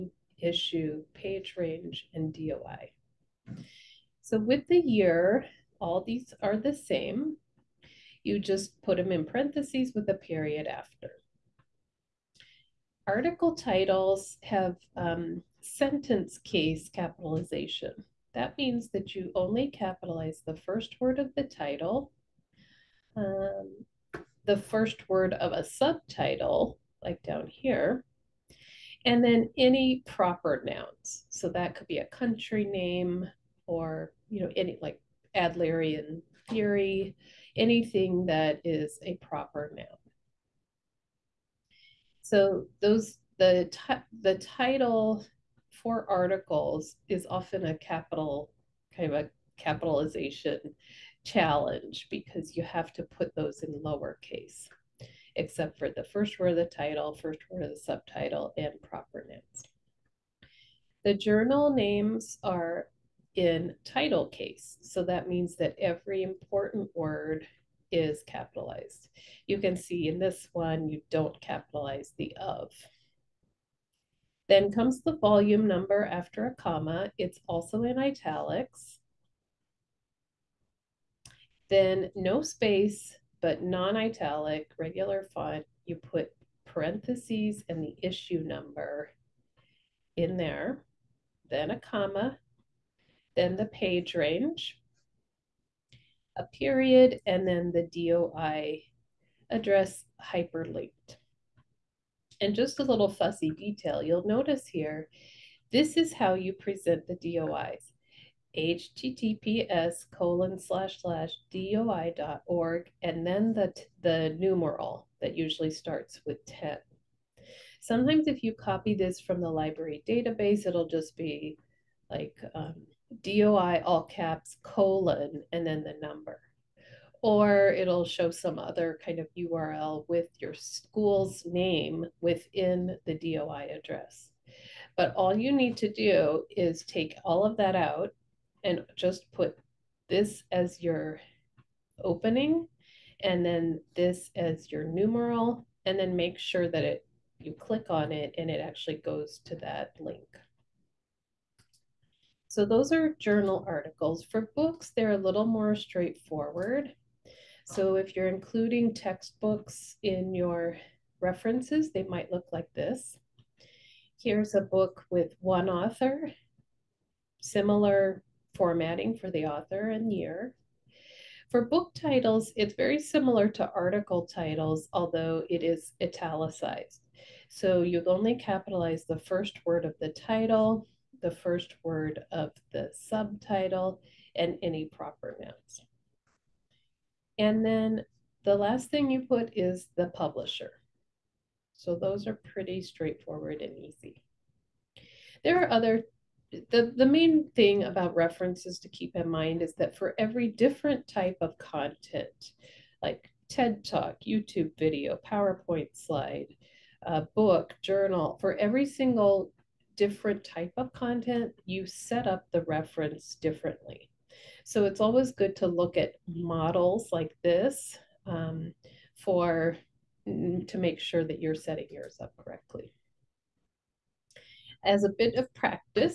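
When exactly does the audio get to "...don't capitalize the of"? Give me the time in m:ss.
1:11.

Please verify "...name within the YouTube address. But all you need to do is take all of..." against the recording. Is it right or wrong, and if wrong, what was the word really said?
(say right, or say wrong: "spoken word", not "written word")
wrong: "DOI", not "YouTube".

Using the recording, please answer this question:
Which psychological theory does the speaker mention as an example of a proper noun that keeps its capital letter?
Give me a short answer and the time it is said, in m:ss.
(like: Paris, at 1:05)
Adlerian theory, at 0:35.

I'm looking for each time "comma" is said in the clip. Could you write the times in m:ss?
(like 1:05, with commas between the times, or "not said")
1:16, 1:31.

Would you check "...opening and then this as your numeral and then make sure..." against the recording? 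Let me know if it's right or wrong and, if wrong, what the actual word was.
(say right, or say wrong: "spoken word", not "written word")
right.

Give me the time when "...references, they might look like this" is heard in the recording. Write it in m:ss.
2:41.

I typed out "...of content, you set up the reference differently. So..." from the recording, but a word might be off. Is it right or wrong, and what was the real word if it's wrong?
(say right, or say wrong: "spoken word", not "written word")
right.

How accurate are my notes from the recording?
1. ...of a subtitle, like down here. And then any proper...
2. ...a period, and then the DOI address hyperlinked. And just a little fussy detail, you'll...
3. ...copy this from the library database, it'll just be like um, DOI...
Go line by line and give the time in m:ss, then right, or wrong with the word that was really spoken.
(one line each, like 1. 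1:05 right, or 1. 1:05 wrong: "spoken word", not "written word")
1. 0:25 right
2. 1:36 right
3. 1:58 right.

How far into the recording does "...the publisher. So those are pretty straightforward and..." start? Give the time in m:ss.
3:09.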